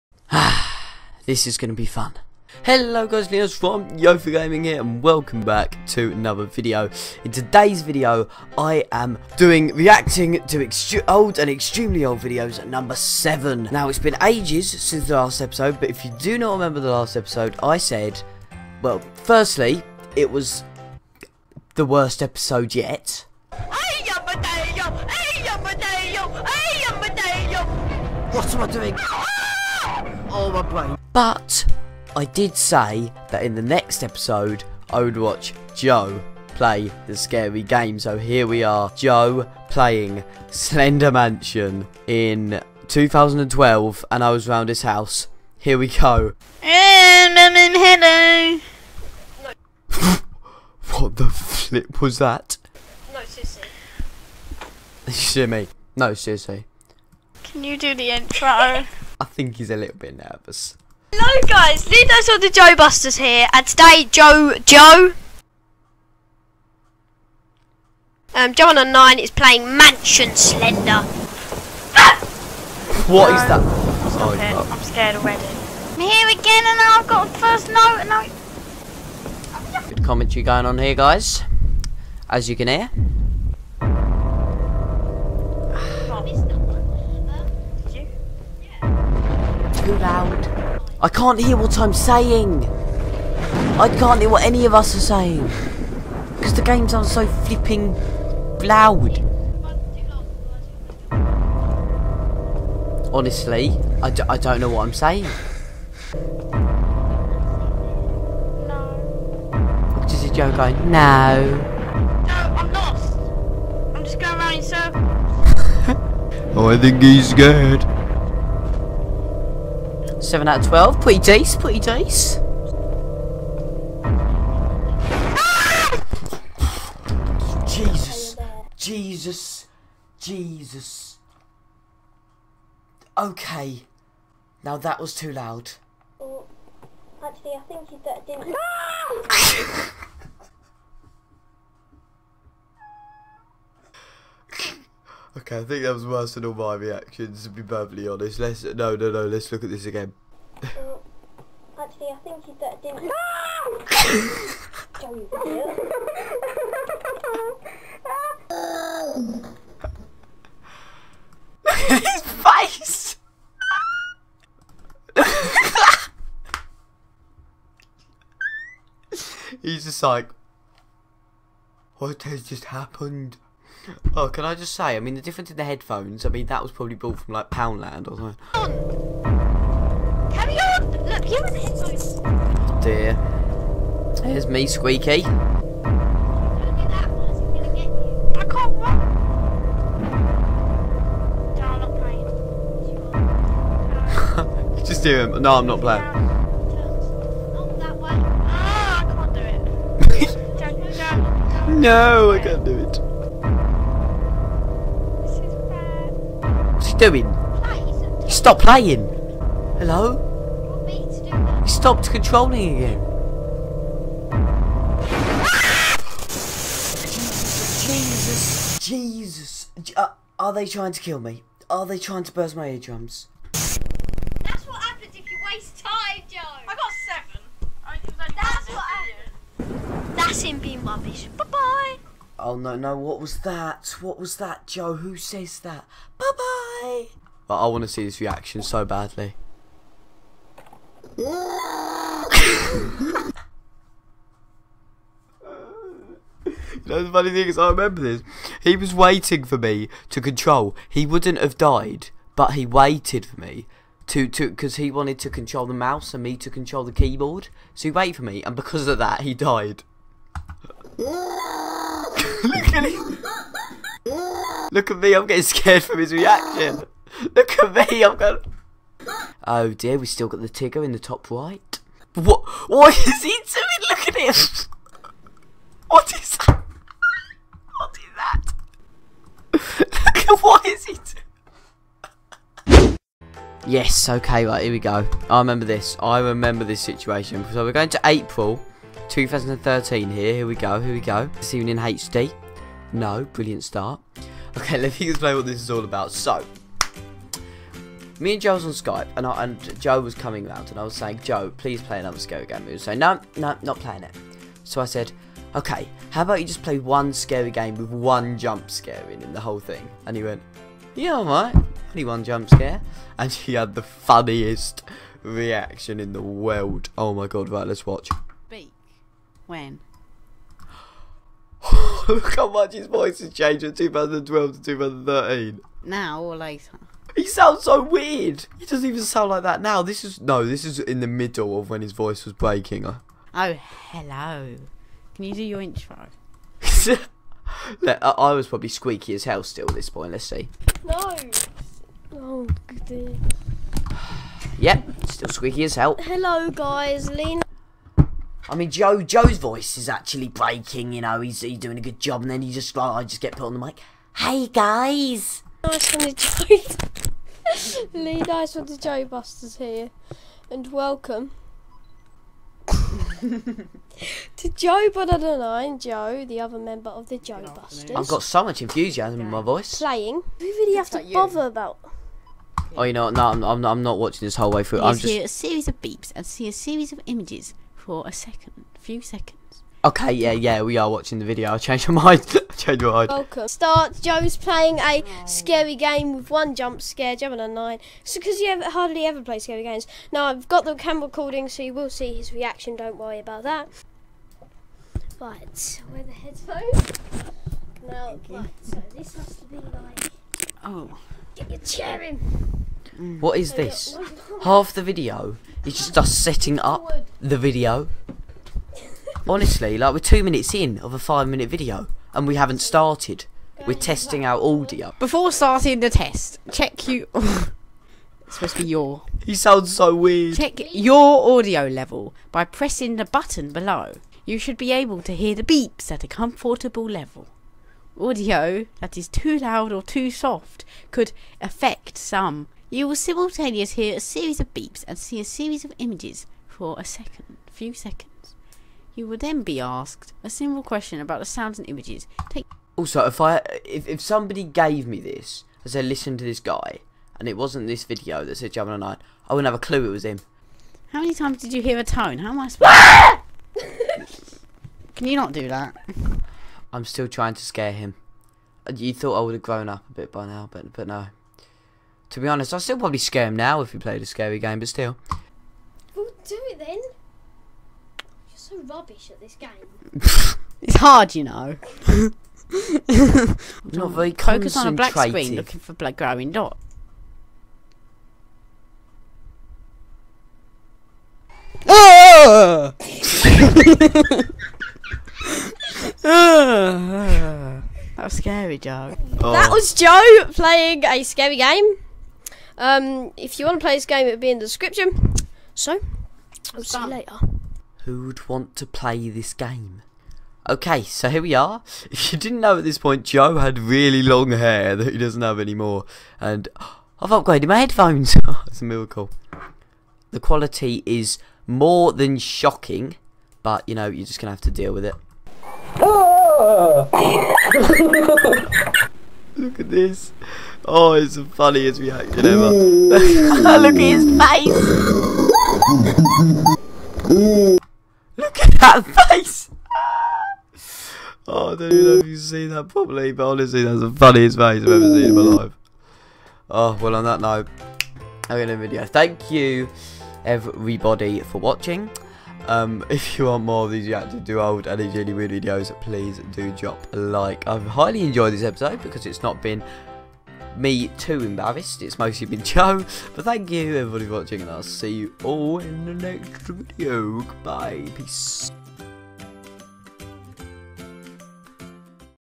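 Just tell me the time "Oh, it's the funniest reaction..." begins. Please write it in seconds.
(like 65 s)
520 s.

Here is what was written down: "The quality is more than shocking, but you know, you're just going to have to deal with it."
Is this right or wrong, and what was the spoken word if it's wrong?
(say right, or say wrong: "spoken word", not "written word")
right.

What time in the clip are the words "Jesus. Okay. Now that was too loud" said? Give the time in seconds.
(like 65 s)
130 s.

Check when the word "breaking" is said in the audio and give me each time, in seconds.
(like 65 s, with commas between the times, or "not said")
332 s, 350 s.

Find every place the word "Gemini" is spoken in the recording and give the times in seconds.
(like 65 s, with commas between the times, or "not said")
387 s, 448 s.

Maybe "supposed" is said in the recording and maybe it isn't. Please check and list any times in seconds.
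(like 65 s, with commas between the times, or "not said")
418 s, 452 s.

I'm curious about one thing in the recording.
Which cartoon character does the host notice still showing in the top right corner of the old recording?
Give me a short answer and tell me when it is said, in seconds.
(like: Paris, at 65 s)
Tigger, at 270 s.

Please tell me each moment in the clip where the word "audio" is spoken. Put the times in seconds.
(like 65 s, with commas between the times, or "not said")
414 s, 421 s, 427 s.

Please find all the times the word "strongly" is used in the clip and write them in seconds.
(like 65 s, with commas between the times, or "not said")
not said.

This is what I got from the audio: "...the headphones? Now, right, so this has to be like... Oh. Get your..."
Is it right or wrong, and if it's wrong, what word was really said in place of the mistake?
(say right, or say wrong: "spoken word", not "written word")
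right.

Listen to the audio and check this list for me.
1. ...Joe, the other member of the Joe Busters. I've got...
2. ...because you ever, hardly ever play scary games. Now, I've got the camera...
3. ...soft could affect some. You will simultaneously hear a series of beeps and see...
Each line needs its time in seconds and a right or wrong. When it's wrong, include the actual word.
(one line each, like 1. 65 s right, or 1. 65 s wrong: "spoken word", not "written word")
1. 365 s right
2. 388 s right
3. 430 s right.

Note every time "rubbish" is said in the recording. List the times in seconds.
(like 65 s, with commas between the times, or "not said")
230 s, 468 s.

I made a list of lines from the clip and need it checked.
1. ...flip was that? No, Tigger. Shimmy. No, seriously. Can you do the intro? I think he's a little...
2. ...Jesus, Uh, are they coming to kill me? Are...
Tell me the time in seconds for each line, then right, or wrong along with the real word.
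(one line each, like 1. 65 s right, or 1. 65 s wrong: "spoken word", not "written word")
1. 51 s wrong: "Sissy", not "Tigger"
2. 218 s wrong: "trying", not "coming".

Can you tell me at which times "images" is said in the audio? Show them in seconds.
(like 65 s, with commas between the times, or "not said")
377 s, 435 s, 441 s.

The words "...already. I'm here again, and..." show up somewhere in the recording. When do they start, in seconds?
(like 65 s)
75 s.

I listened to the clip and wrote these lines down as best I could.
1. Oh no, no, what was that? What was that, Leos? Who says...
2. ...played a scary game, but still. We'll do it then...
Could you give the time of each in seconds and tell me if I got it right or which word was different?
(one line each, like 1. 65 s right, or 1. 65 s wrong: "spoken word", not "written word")
1. 232 s wrong: "Joe", not "Leos"
2. 463 s right.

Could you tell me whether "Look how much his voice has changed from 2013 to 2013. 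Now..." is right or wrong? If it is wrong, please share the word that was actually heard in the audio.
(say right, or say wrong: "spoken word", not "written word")
wrong: "2012", not "2013".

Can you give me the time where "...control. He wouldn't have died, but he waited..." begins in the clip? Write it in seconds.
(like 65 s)
250 s.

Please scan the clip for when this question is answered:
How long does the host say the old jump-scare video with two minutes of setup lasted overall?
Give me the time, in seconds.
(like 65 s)
410 s.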